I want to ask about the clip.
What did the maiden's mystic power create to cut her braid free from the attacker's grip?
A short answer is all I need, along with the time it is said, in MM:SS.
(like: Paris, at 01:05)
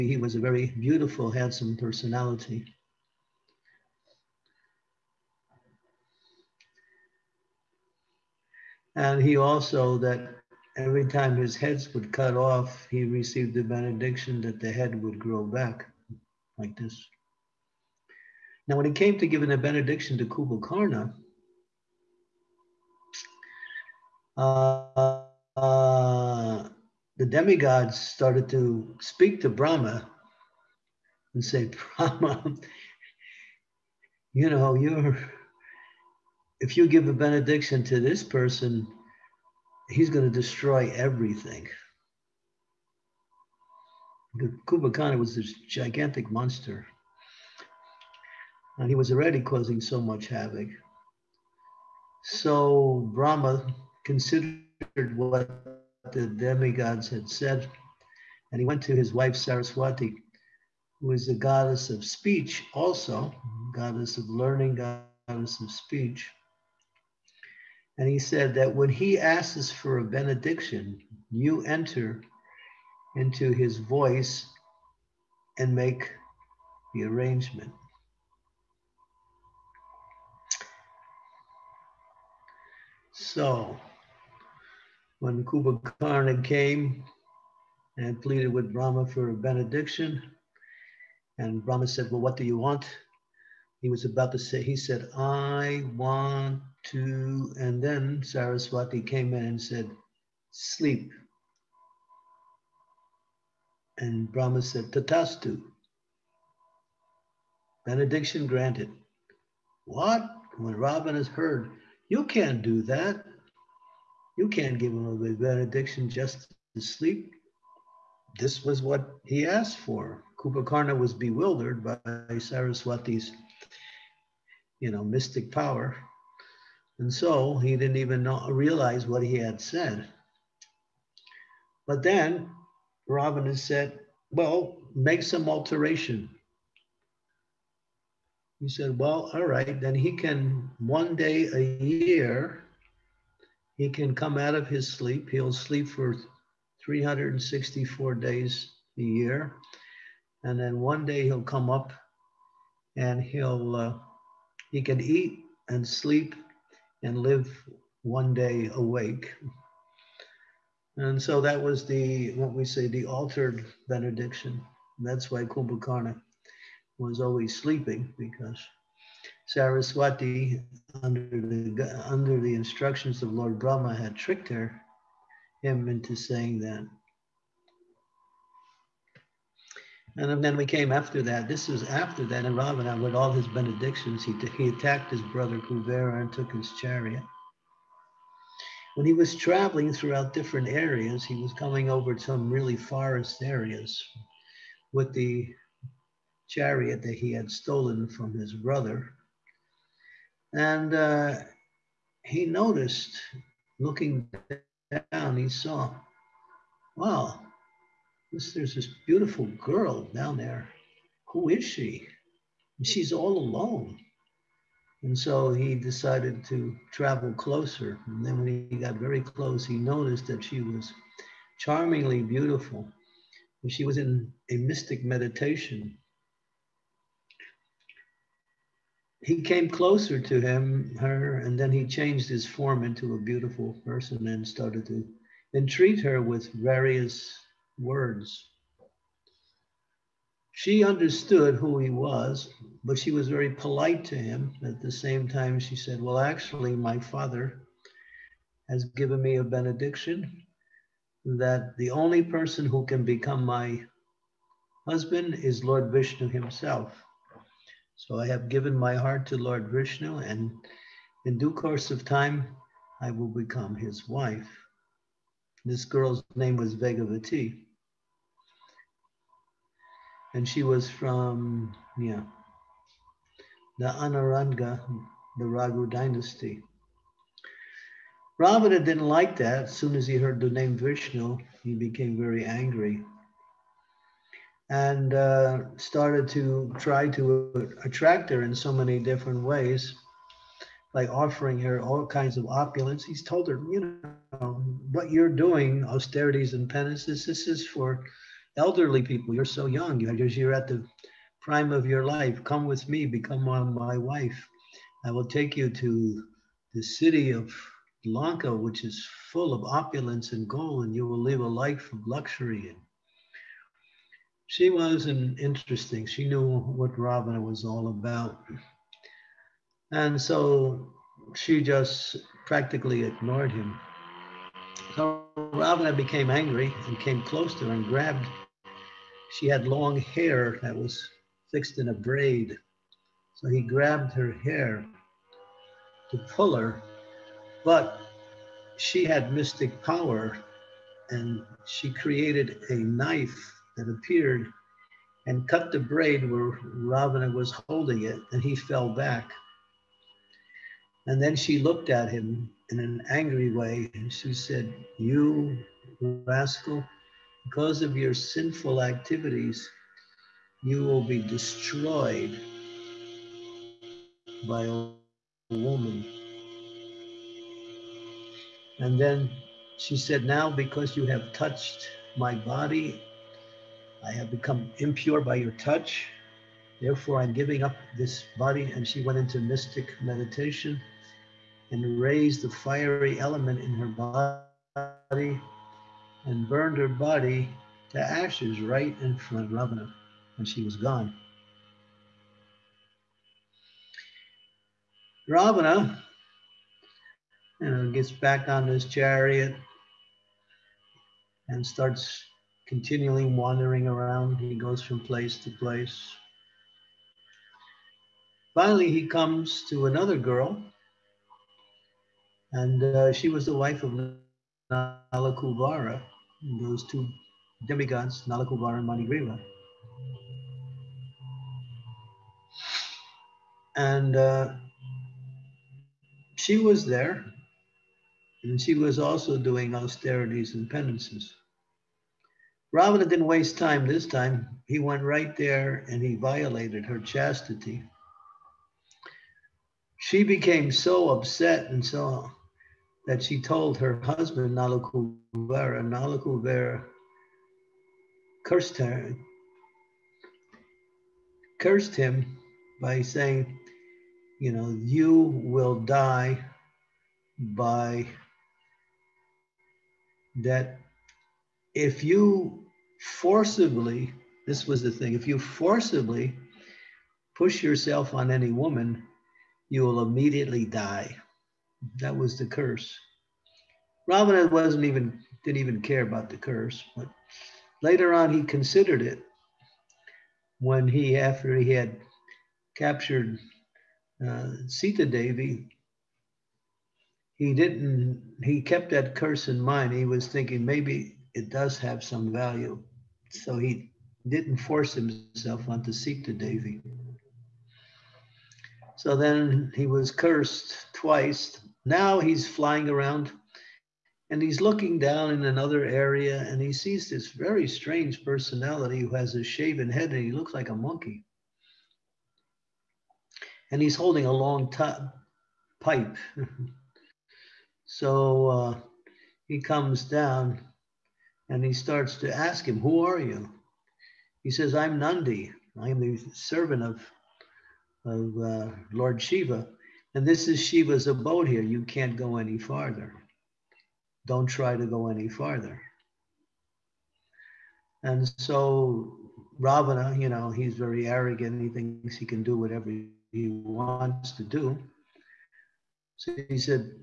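A knife, at 05:42.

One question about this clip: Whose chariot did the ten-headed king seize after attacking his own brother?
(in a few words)
Kuvera.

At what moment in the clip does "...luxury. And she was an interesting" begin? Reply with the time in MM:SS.
05:12.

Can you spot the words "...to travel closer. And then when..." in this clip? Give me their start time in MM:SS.
03:36.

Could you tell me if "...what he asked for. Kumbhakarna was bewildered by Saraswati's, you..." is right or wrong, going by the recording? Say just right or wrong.
right.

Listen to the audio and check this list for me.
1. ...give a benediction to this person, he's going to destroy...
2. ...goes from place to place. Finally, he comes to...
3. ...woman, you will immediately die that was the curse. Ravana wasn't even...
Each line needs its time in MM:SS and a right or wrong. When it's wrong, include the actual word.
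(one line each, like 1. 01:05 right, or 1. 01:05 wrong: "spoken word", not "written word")
1. 00:36 right
2. 06:44 right
3. 07:48 right.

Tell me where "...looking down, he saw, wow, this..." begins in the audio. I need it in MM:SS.
03:23.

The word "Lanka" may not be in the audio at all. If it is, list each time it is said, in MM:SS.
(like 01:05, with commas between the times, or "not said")
05:08.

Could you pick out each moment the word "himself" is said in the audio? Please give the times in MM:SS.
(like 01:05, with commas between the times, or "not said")
04:16, 08:14.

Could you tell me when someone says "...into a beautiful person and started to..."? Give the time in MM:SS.
03:52.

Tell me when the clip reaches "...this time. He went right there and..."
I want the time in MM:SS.
07:13.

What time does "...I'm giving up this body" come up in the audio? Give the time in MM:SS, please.
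06:17.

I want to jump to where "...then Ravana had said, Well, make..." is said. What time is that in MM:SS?
02:12.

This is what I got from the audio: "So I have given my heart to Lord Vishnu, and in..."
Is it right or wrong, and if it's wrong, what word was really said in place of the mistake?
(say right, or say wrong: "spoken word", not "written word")
right.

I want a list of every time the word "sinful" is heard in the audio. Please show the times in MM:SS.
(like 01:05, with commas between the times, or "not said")
05:58.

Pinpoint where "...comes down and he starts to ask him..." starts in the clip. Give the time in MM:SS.
08:39.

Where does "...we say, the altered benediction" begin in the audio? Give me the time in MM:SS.
02:42.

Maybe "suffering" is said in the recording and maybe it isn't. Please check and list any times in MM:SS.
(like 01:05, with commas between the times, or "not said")
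not said.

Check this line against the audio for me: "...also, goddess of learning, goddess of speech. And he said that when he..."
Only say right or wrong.
right.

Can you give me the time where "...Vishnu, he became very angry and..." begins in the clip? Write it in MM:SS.
04:40.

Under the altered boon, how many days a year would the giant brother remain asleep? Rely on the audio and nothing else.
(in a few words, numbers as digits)
364.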